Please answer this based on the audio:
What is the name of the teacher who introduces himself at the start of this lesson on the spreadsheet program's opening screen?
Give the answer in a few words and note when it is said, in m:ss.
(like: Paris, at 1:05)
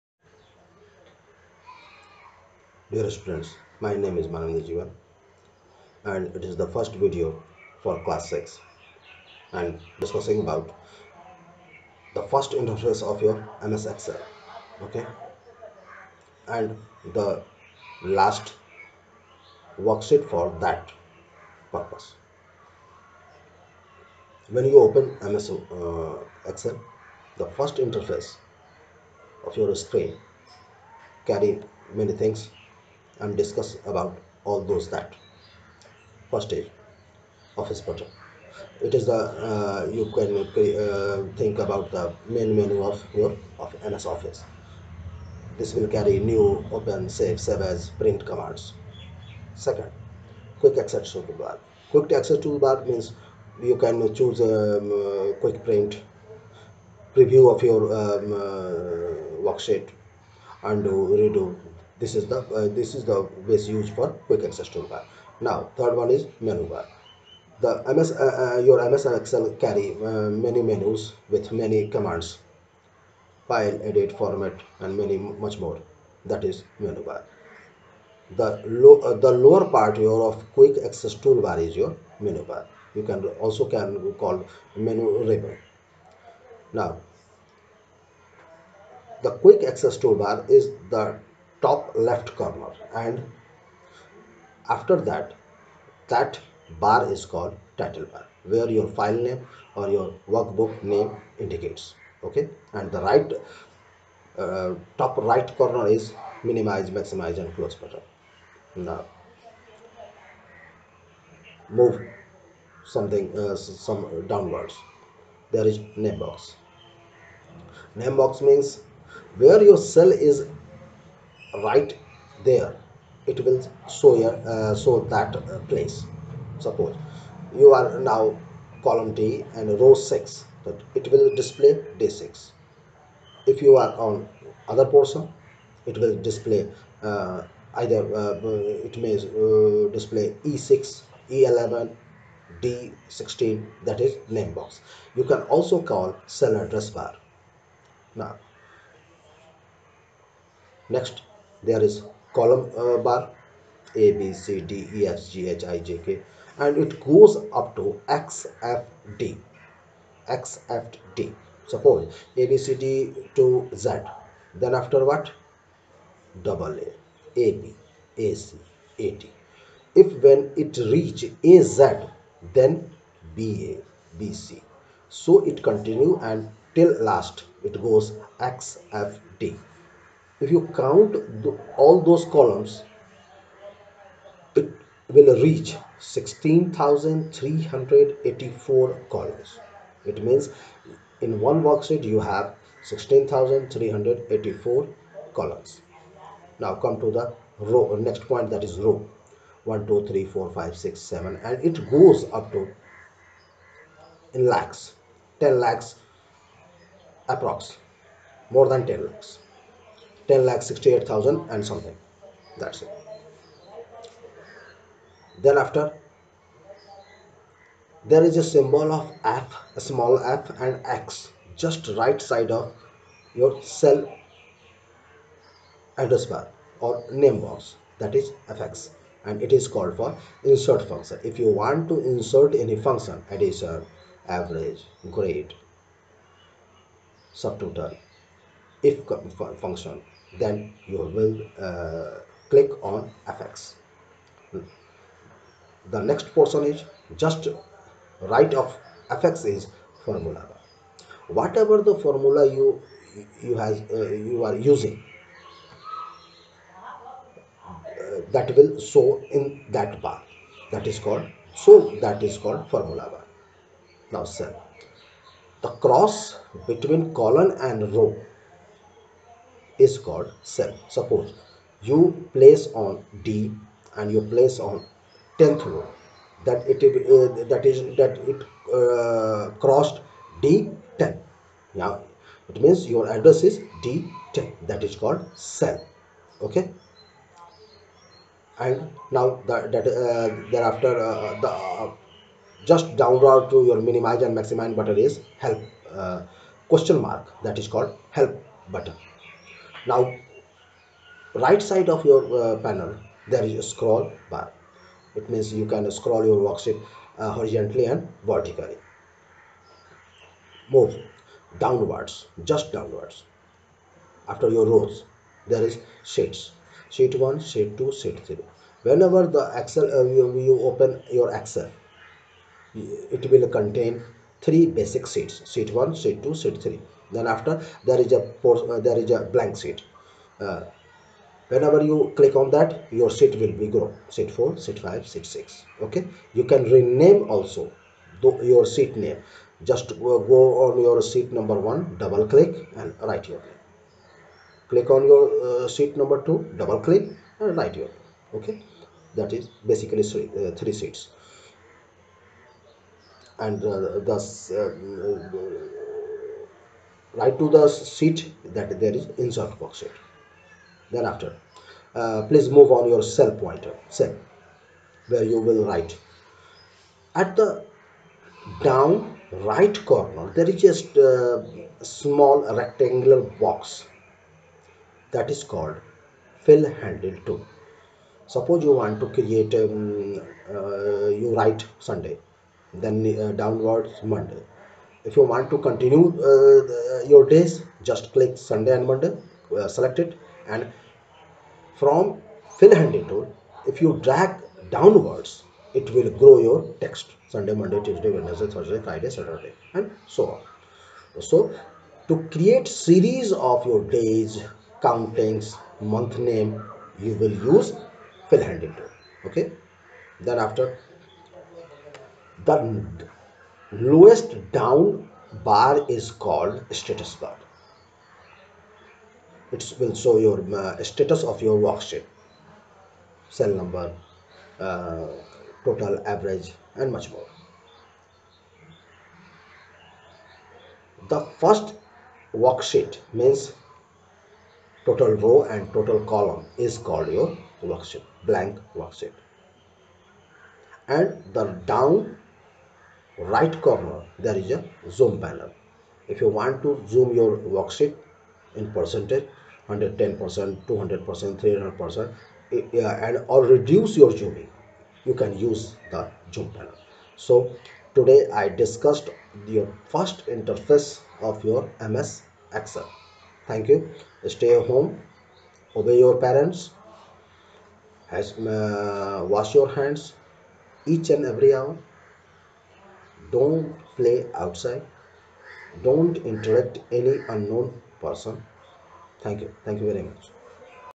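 Manandi Jivan, at 0:04.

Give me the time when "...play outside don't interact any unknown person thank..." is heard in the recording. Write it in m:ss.
7:53.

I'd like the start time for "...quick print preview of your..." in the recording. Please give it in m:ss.
0:55.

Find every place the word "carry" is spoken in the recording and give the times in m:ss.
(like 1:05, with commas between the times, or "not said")
0:31, 0:45, 1:09.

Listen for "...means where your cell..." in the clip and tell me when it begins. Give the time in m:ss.
1:58.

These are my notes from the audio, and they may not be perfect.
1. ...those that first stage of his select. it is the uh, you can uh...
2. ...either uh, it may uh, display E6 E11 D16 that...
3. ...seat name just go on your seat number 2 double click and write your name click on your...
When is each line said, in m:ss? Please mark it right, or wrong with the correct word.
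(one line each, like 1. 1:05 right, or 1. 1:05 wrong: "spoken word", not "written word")
1. 0:34 wrong: "project", not "select"
2. 2:17 right
3. 5:38 wrong: "1", not "2".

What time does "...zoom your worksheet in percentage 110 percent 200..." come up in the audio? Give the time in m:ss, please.
7:26.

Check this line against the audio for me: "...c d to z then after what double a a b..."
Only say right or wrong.
right.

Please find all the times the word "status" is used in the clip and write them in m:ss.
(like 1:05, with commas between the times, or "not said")
6:56, 7:00.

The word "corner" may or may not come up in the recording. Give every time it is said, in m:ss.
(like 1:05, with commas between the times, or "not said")
1:32, 1:45, 6:09, 7:23.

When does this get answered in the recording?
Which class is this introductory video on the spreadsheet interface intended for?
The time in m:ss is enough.
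0:08.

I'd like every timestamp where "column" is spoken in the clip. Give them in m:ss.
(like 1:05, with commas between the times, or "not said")
2:08, 2:32, 3:02, 3:09, 3:15, 4:27, 7:16.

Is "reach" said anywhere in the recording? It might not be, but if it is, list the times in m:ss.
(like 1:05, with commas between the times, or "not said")
2:50, 3:05.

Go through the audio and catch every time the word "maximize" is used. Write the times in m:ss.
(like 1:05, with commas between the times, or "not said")
1:46, 4:54.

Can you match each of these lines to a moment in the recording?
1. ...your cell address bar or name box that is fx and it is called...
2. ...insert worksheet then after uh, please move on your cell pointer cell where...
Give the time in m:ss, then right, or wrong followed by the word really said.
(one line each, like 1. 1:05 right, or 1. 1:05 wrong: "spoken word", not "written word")
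1. 3:43 right
2. 5:59 right.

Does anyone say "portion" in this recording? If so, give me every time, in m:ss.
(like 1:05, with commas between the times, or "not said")
2:14, 4:06.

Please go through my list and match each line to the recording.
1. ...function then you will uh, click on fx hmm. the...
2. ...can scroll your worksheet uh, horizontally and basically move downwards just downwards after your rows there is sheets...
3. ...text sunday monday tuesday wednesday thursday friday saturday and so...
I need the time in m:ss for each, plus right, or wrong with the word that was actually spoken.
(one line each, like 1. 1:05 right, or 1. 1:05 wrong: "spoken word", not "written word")
1. 3:59 right
2. 5:05 wrong: "vertically", not "basically"
3. 6:36 right.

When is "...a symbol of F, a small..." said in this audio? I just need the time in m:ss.
3:38.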